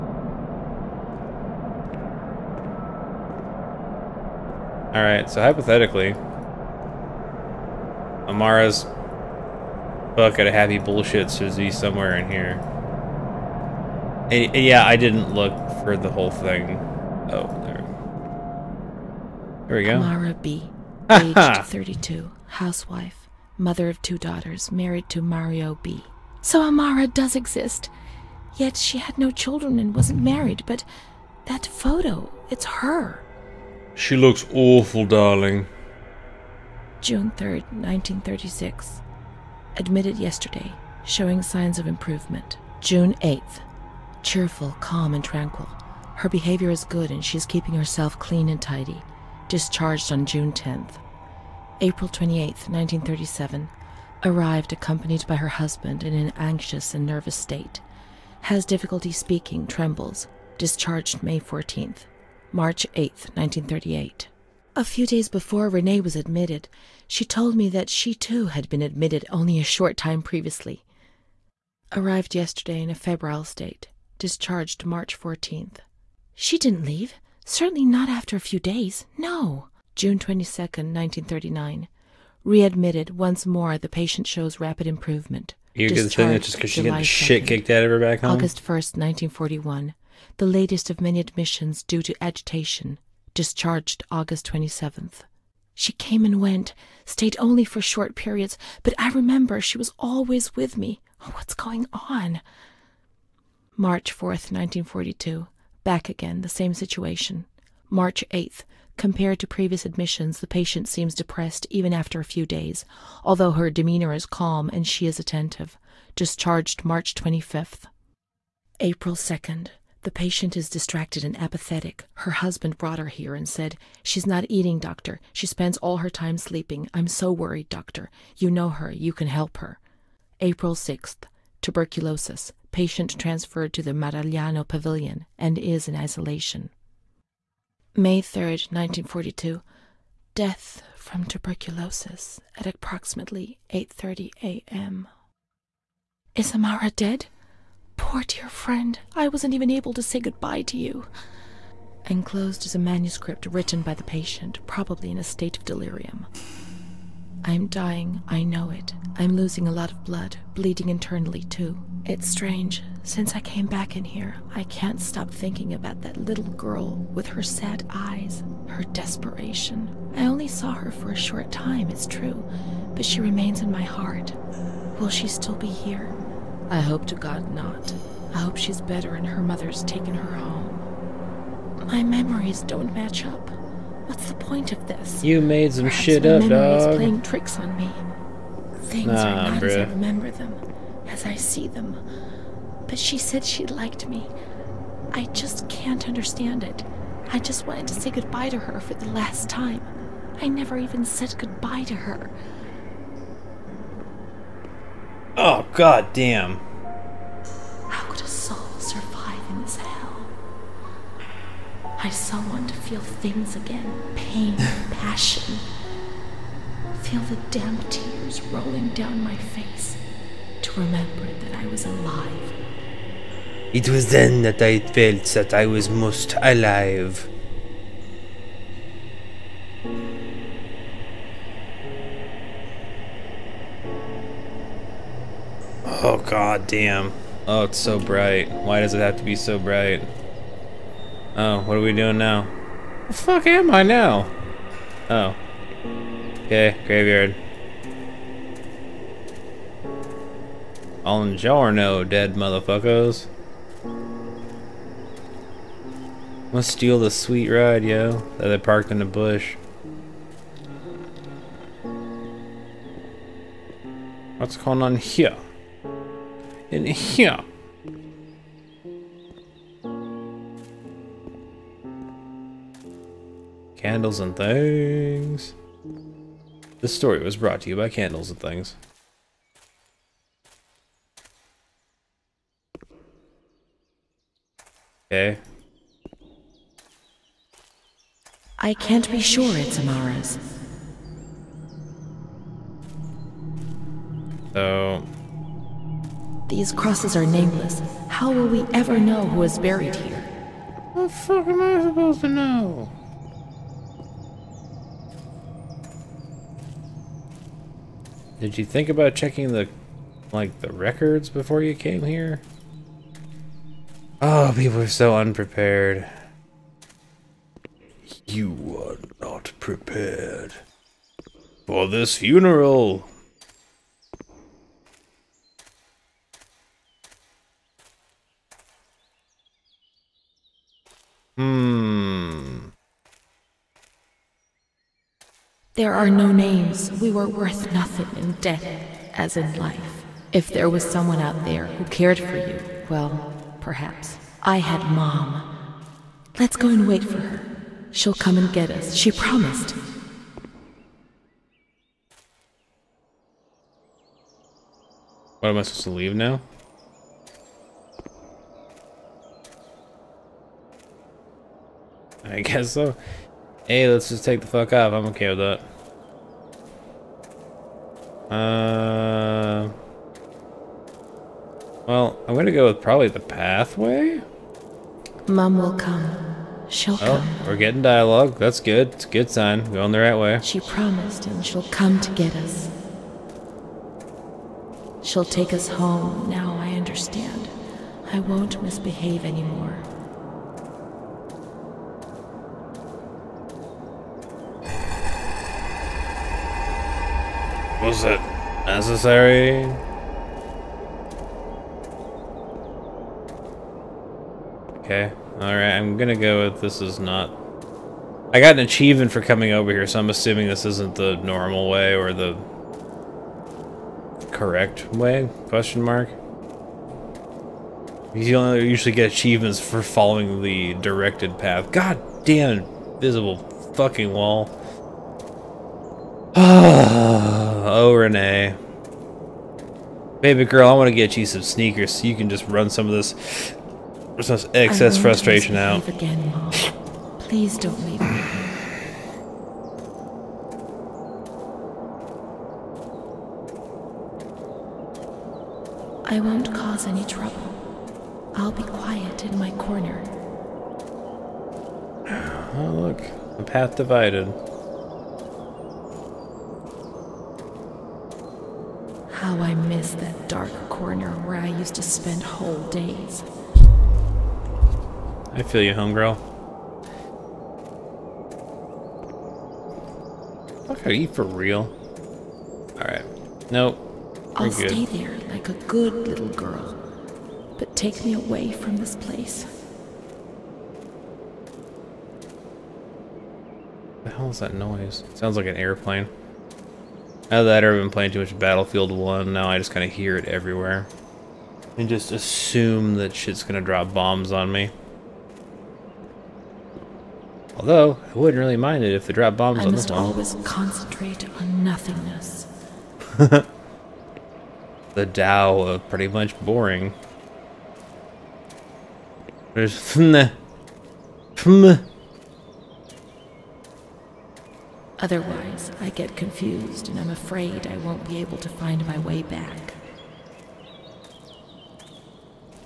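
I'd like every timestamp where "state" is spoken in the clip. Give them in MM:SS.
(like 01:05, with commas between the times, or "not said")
00:57, 01:13, 02:35.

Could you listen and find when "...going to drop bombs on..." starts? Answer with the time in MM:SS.
08:13.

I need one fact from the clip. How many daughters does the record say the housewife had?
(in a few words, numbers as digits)
2.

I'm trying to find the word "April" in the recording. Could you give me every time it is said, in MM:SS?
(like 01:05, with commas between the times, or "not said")
00:51, 01:58, 02:10.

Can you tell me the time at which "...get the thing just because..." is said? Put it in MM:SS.
01:25.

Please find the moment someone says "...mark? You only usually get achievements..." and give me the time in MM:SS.
06:55.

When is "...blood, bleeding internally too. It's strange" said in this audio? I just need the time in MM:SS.
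02:40.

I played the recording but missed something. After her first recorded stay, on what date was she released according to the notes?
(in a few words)
June 10th.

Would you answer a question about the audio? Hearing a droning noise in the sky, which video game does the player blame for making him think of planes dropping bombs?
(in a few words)
Battlefield 1.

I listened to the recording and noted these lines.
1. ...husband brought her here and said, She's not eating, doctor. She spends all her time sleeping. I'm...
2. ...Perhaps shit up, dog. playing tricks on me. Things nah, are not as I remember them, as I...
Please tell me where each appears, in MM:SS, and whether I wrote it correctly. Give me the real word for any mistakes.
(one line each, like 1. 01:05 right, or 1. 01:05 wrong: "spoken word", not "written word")
1. 02:02 right
2. 03:05 right.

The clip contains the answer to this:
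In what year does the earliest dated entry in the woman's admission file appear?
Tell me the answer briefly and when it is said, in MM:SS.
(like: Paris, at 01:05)
1936, at 00:37.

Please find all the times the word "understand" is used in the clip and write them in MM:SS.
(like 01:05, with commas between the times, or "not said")
03:16, 06:26.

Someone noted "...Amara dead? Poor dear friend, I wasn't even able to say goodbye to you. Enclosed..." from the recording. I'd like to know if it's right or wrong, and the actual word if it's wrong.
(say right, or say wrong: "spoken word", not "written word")
right.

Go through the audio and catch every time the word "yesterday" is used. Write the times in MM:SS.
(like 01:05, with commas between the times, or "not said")
00:40, 01:12.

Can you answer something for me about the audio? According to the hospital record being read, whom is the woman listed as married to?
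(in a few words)
Mario B.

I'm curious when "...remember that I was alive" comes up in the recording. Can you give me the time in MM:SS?
03:40.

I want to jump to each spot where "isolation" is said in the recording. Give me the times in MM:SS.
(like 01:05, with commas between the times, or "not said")
02:15.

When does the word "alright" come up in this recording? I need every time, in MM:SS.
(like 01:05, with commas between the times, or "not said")
00:04, 06:45, 07:52.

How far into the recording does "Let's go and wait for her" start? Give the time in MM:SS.
05:46.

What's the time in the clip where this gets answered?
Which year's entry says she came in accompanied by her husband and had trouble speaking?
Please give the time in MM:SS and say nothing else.
00:52.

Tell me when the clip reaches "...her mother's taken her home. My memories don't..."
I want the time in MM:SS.
02:59.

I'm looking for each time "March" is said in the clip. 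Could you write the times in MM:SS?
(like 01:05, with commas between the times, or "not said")
01:02, 01:14, 01:43, 01:47, 01:56.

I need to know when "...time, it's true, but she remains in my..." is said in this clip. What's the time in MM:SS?
02:51.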